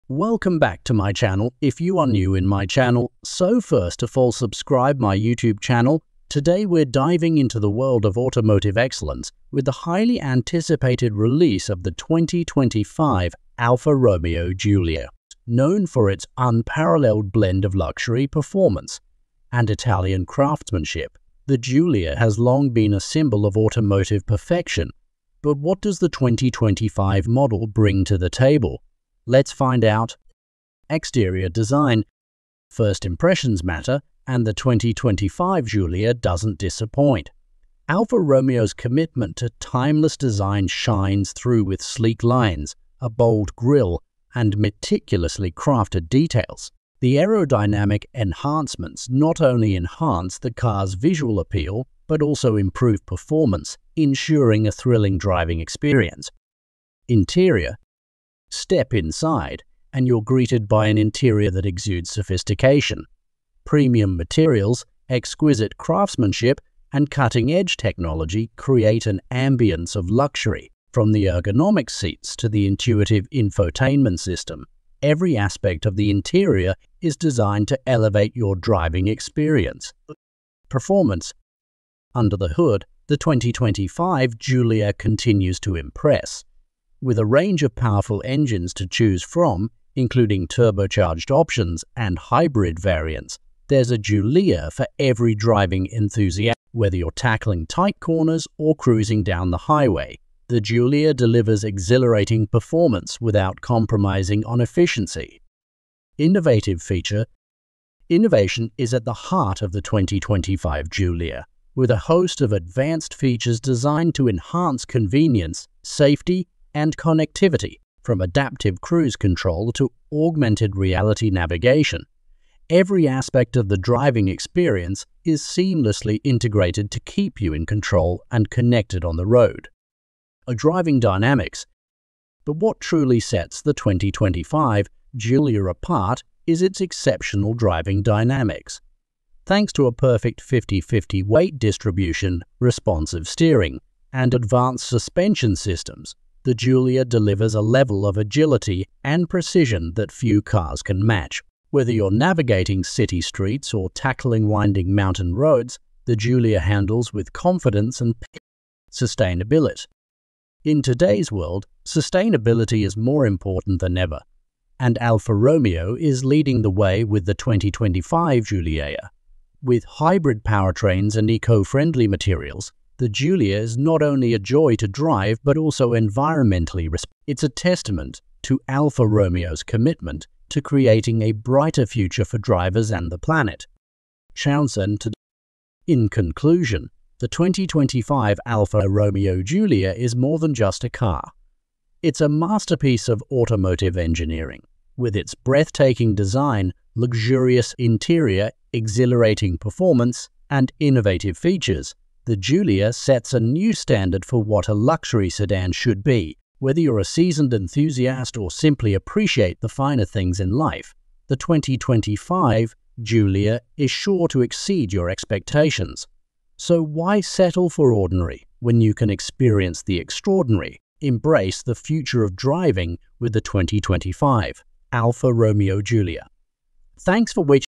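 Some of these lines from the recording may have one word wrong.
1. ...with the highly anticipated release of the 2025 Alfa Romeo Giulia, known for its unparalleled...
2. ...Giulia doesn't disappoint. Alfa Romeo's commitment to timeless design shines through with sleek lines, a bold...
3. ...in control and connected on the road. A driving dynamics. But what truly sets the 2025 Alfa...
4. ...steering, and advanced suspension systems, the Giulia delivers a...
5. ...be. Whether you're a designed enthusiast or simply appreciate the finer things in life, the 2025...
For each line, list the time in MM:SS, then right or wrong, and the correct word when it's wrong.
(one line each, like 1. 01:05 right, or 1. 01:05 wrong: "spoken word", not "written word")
1. 00:09 right
2. 00:35 right
3. 02:07 wrong: "Giulia", not "Alfa"
4. 02:23 right
5. 03:26 wrong: "seasoned", not "designed".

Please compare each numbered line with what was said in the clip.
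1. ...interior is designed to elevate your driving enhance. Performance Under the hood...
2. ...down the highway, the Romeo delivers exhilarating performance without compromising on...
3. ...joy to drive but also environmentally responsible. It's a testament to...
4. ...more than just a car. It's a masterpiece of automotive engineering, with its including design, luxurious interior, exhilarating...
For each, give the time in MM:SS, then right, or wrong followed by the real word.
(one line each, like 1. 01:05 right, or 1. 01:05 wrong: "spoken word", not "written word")
1. 01:16 wrong: "experience", not "enhance"
2. 01:39 wrong: "Giulia", not "Romeo"
3. 02:54 right
4. 03:10 wrong: "breathtaking", not "including".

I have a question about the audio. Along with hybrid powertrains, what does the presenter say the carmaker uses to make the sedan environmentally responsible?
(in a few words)
Eco-friendly materials.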